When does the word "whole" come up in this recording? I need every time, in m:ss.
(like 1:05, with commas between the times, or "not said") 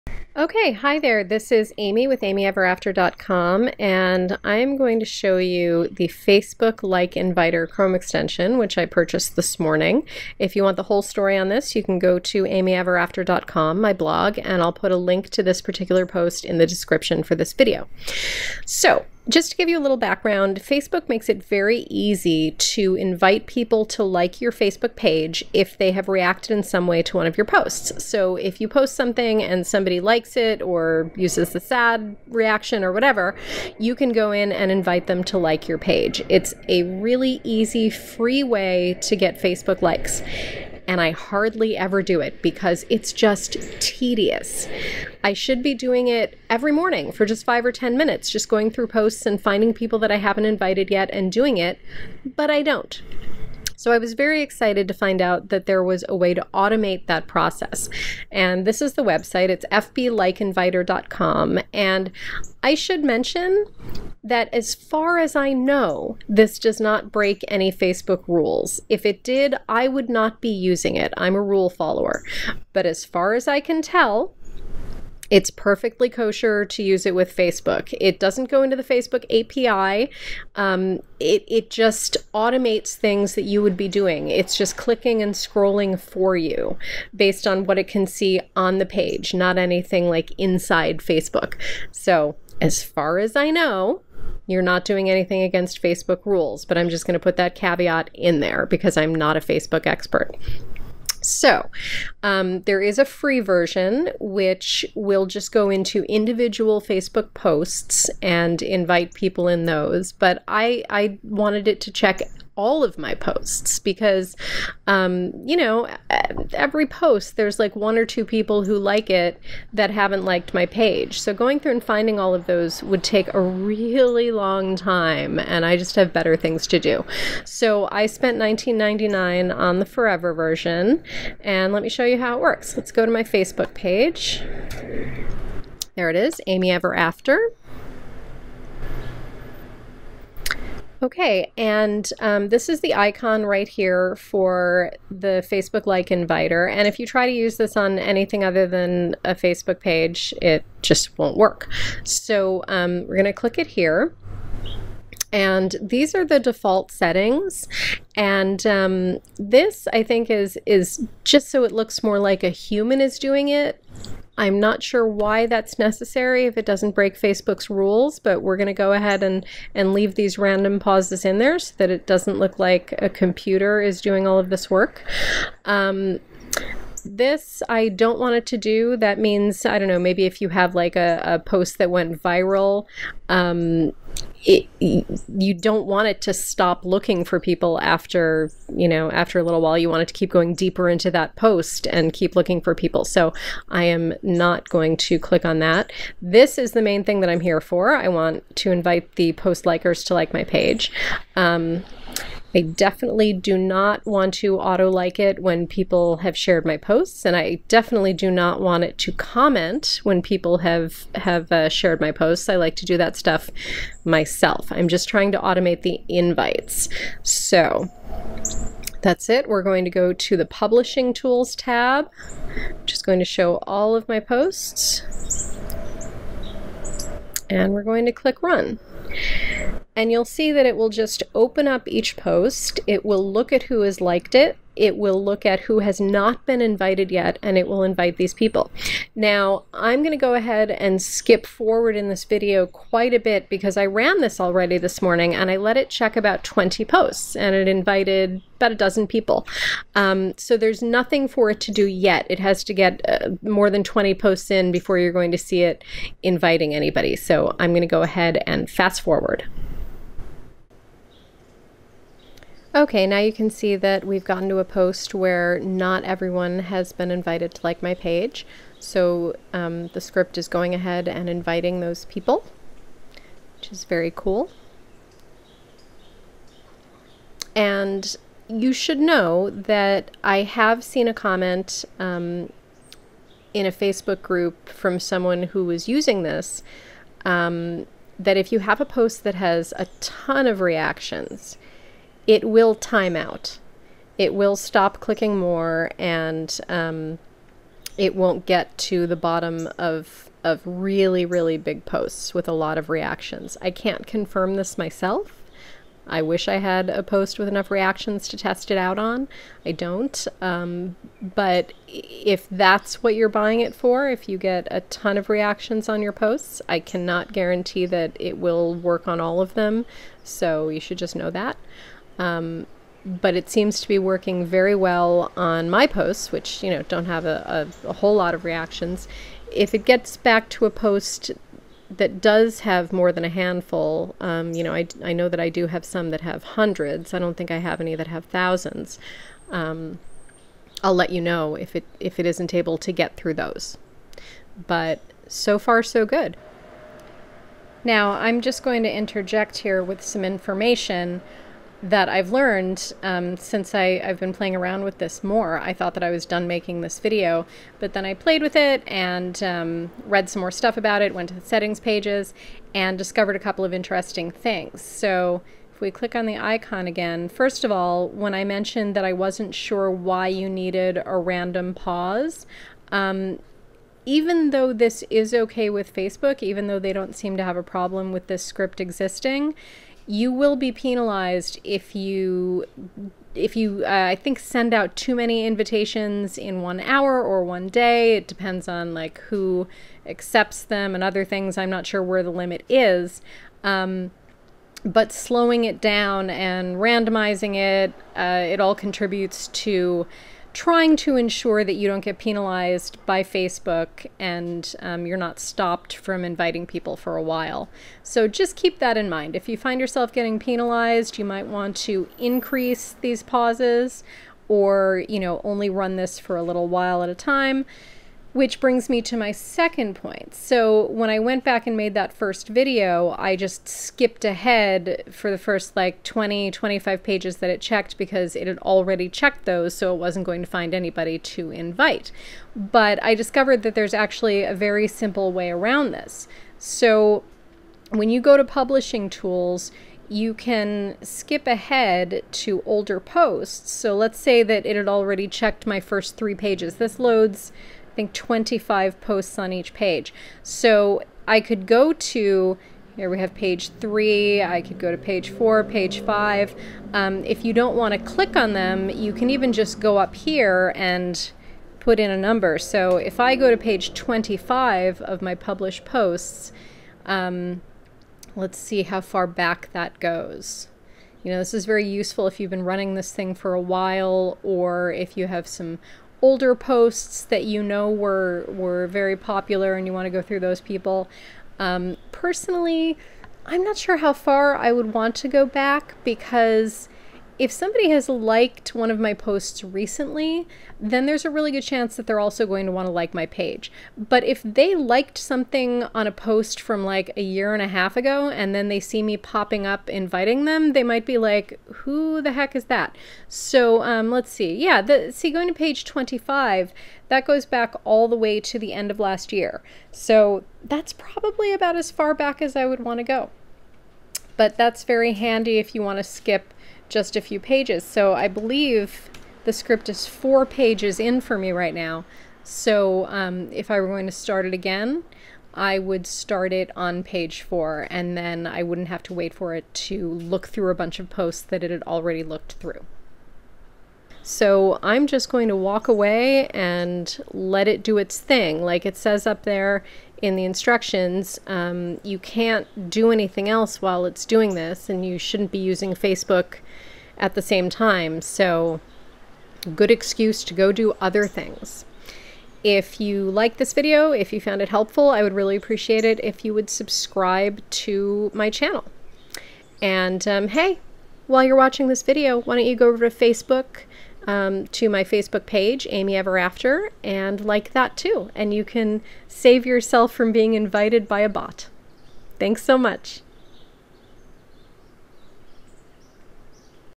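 0:10, 5:27.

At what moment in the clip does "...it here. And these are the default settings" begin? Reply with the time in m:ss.
2:33.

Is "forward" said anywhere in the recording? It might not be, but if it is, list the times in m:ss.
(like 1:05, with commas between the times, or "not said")
4:01, 4:19.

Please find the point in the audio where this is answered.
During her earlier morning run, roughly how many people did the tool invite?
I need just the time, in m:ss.
4:08.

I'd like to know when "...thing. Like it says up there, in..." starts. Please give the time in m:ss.
8:58.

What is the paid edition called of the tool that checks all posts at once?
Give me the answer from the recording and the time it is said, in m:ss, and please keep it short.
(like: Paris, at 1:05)
Forever, at 2:09.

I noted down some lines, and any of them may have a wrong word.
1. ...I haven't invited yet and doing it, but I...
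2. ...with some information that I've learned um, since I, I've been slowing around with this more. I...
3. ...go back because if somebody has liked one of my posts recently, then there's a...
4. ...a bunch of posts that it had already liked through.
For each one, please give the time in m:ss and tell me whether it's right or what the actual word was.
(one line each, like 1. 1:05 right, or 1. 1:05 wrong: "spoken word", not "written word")
1. 0:50 right
2. 5:49 wrong: "playing", not "slowing"
3. 8:05 right
4. 8:50 wrong: "looked", not "liked".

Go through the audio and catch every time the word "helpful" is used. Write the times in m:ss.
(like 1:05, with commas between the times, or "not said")
9:14.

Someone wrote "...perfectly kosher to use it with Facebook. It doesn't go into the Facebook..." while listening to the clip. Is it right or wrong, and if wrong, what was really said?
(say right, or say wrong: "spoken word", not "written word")
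right.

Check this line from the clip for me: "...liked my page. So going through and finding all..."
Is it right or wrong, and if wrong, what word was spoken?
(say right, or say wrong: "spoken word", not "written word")
right.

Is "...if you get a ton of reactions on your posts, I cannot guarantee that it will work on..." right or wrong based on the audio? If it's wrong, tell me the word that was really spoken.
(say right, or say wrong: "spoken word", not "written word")
right.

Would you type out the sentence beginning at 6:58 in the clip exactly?
Which brings me to my second point.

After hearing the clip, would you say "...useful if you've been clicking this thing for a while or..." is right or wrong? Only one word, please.
wrong.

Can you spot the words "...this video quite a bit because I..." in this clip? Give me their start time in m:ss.
4:02.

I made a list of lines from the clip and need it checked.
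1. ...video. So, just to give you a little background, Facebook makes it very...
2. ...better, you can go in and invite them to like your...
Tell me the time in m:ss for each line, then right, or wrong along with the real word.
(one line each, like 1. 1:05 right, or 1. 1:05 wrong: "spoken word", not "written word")
1. 0:17 right
2. 0:32 wrong: "whatever", not "better".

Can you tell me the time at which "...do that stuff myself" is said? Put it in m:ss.
3:32.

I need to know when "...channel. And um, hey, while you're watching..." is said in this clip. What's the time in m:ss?
9:18.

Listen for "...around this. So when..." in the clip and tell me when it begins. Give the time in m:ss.
7:15.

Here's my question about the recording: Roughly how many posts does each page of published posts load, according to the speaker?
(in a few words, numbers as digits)
25.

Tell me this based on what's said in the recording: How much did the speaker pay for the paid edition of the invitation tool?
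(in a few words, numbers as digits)
$19.99.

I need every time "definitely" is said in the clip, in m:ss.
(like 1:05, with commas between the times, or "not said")
3:22, 3:27.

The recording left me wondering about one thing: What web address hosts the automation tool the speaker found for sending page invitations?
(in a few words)
fblikeinviter.com.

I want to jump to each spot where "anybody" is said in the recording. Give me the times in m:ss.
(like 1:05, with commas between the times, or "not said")
4:16, 7:10.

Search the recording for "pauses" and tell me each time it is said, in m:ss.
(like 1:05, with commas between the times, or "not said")
2:50, 6:11, 6:53.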